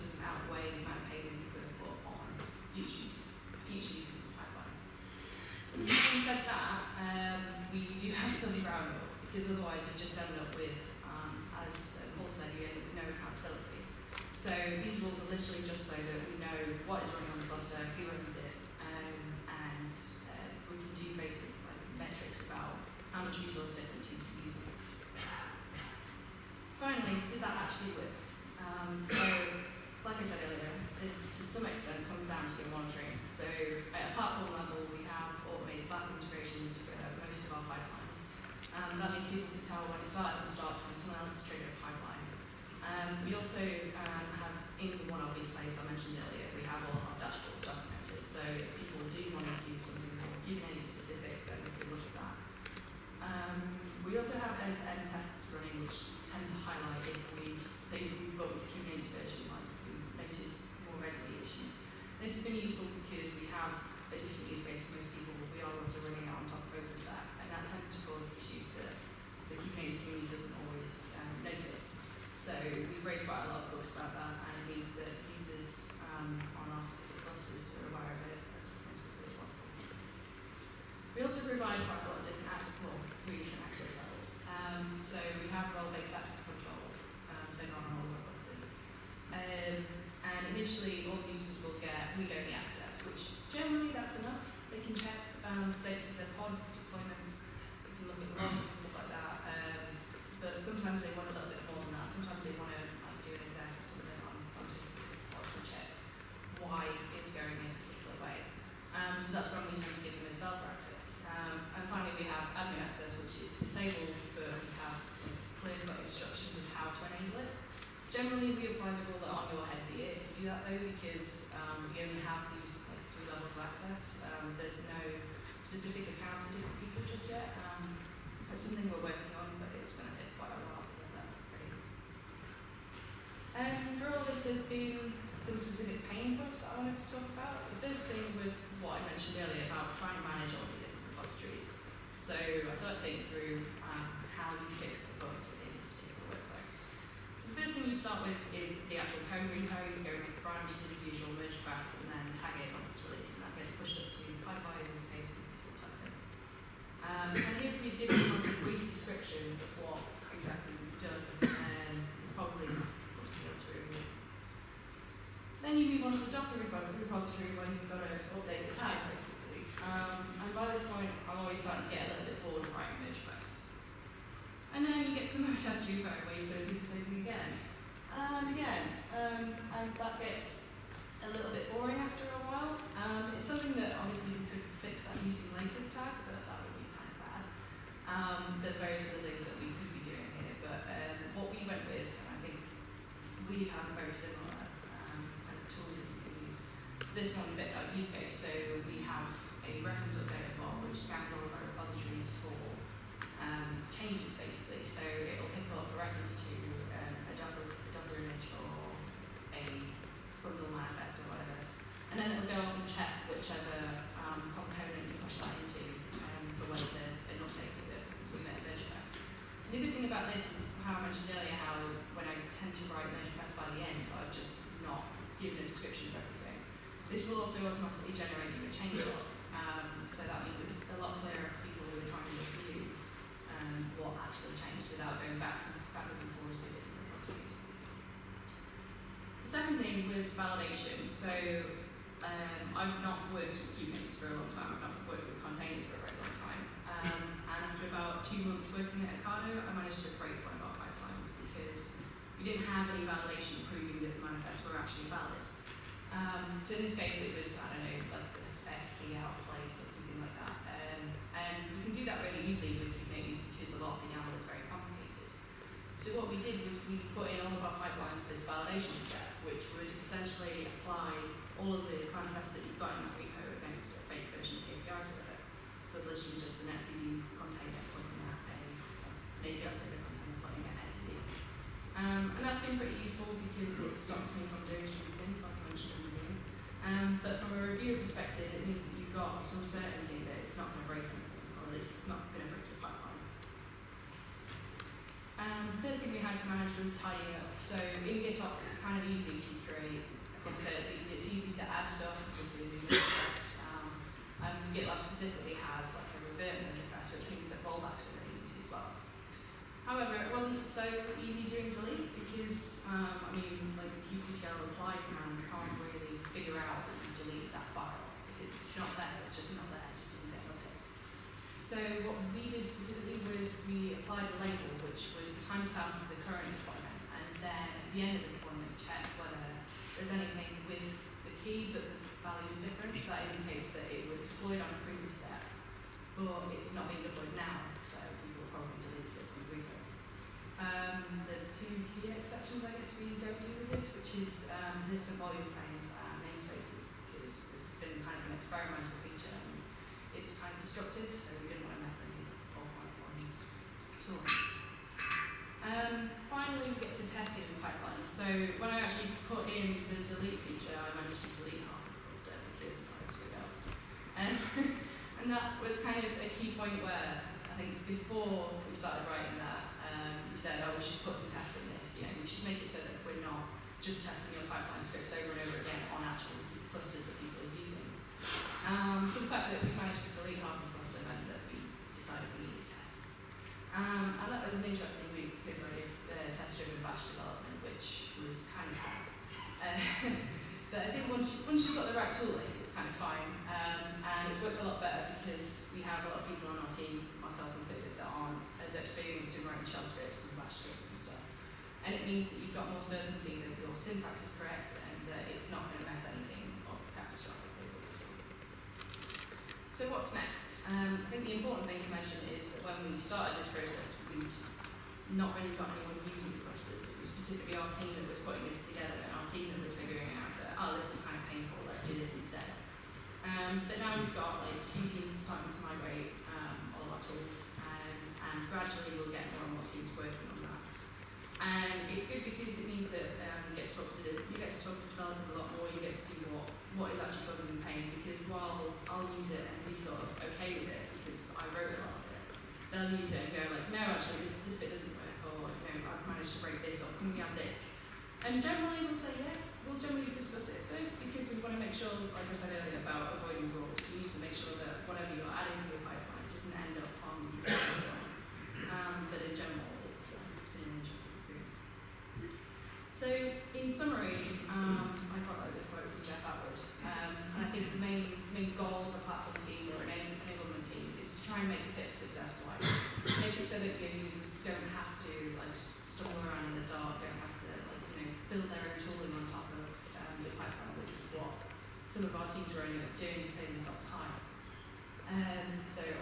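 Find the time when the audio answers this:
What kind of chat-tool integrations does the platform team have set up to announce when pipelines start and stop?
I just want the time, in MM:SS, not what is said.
00:35.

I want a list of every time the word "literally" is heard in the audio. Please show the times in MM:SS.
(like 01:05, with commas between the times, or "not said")
00:15, 04:36.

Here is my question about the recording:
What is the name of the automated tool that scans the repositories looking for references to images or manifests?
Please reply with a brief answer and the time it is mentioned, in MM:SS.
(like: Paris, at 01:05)
reference update bot, at 03:19.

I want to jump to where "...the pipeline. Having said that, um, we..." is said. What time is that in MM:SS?
00:04.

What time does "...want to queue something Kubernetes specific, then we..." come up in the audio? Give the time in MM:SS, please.
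00:49.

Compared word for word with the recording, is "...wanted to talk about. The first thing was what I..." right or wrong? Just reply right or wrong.
right.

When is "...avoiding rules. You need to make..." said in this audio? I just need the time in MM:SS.
07:33.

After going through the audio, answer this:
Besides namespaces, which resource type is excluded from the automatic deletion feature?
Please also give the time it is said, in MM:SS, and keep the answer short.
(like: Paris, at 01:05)
persistent volume claims, at 05:44.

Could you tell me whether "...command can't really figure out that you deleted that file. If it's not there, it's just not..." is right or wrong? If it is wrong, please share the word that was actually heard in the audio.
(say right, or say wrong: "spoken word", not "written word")
right.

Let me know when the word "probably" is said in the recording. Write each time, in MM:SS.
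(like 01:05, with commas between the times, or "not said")
05:38.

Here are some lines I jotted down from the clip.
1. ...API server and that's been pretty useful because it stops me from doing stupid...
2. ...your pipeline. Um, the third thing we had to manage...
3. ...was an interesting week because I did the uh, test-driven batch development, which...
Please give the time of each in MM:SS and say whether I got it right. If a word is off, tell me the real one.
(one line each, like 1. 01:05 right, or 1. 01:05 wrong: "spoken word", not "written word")
1. 04:39 right
2. 04:52 right
3. 06:24 right.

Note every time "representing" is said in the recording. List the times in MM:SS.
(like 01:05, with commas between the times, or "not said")
not said.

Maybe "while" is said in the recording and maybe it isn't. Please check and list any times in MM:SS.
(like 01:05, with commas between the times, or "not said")
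02:10, 07:18.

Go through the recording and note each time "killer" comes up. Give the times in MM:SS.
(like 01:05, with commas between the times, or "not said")
not said.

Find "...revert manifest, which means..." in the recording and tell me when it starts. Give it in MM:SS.
05:06.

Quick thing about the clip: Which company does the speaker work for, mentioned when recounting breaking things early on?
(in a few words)
Ocado.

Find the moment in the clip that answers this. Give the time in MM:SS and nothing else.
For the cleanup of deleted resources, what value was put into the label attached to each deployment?
05:25.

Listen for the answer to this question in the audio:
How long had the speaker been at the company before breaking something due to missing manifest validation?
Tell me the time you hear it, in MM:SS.
04:08.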